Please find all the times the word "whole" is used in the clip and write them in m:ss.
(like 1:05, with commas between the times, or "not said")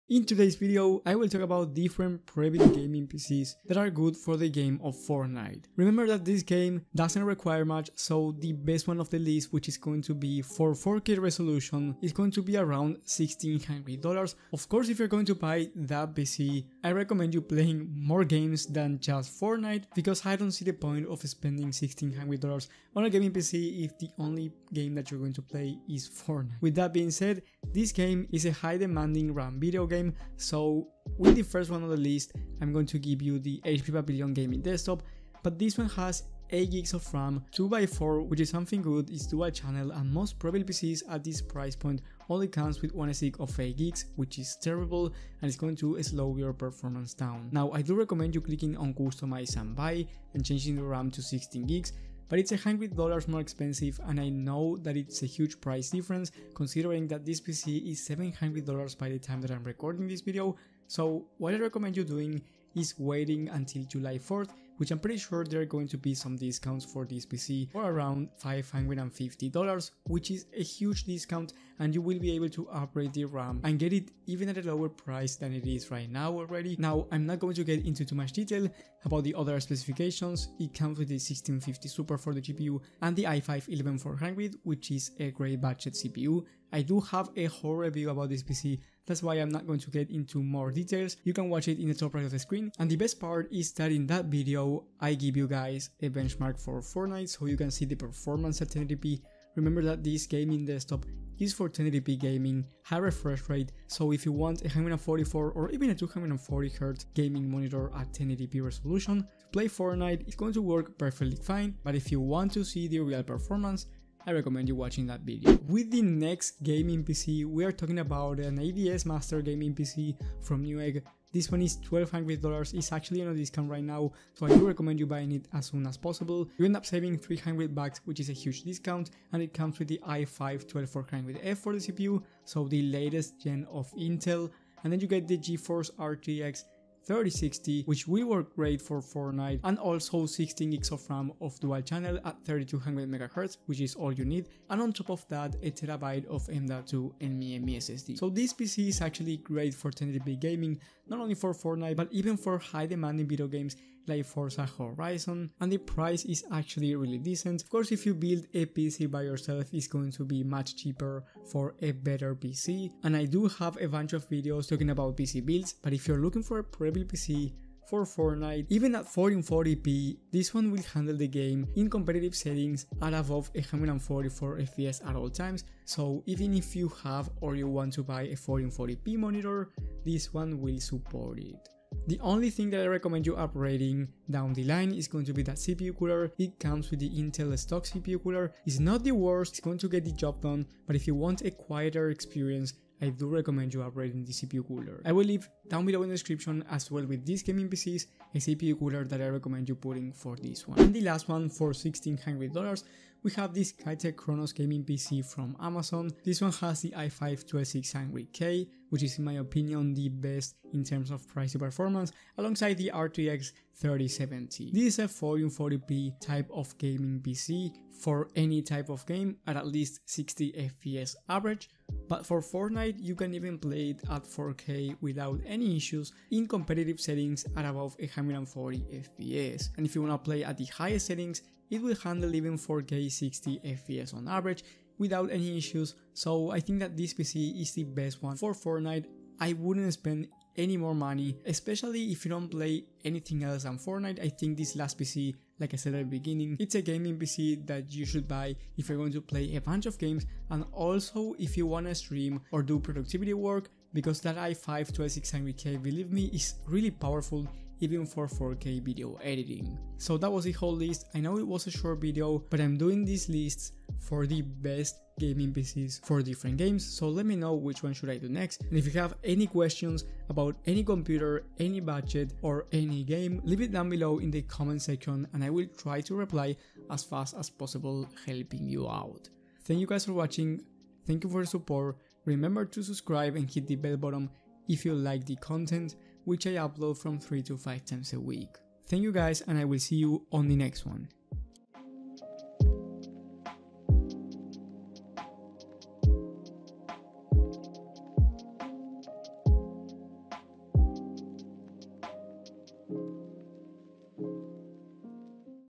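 1:27, 4:20.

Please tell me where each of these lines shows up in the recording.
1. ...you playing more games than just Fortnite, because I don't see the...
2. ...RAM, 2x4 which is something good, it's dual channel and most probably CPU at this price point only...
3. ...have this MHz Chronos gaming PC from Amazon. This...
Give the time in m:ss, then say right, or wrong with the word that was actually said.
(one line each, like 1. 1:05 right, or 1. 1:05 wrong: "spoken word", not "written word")
1. 0:17 right
2. 0:37 wrong: "PCs", not "CPU"
3. 3:23 wrong: "Skytech", not "MHz".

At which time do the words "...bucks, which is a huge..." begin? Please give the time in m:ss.
2:07.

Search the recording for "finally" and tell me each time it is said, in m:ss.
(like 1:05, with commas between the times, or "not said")
not said.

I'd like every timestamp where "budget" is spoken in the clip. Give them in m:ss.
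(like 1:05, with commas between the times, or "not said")
1:25, 4:31.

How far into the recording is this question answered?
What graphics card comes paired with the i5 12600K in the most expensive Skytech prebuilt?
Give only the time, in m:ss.
3:32.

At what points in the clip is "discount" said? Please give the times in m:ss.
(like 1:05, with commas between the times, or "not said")
1:06, 1:11, 2:03, 2:08.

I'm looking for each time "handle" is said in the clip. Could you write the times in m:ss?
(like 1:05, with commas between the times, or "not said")
2:50, 3:51.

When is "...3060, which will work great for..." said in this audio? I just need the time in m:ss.
2:17.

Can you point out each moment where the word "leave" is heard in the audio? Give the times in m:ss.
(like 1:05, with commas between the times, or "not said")
3:15, 4:33.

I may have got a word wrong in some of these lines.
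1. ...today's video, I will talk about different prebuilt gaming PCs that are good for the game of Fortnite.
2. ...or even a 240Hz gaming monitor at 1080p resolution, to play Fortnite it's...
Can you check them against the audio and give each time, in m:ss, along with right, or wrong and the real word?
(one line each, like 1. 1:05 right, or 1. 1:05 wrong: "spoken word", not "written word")
1. 0:00 right
2. 1:45 right.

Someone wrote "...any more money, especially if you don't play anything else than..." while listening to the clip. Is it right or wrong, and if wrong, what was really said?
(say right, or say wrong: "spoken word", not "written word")
right.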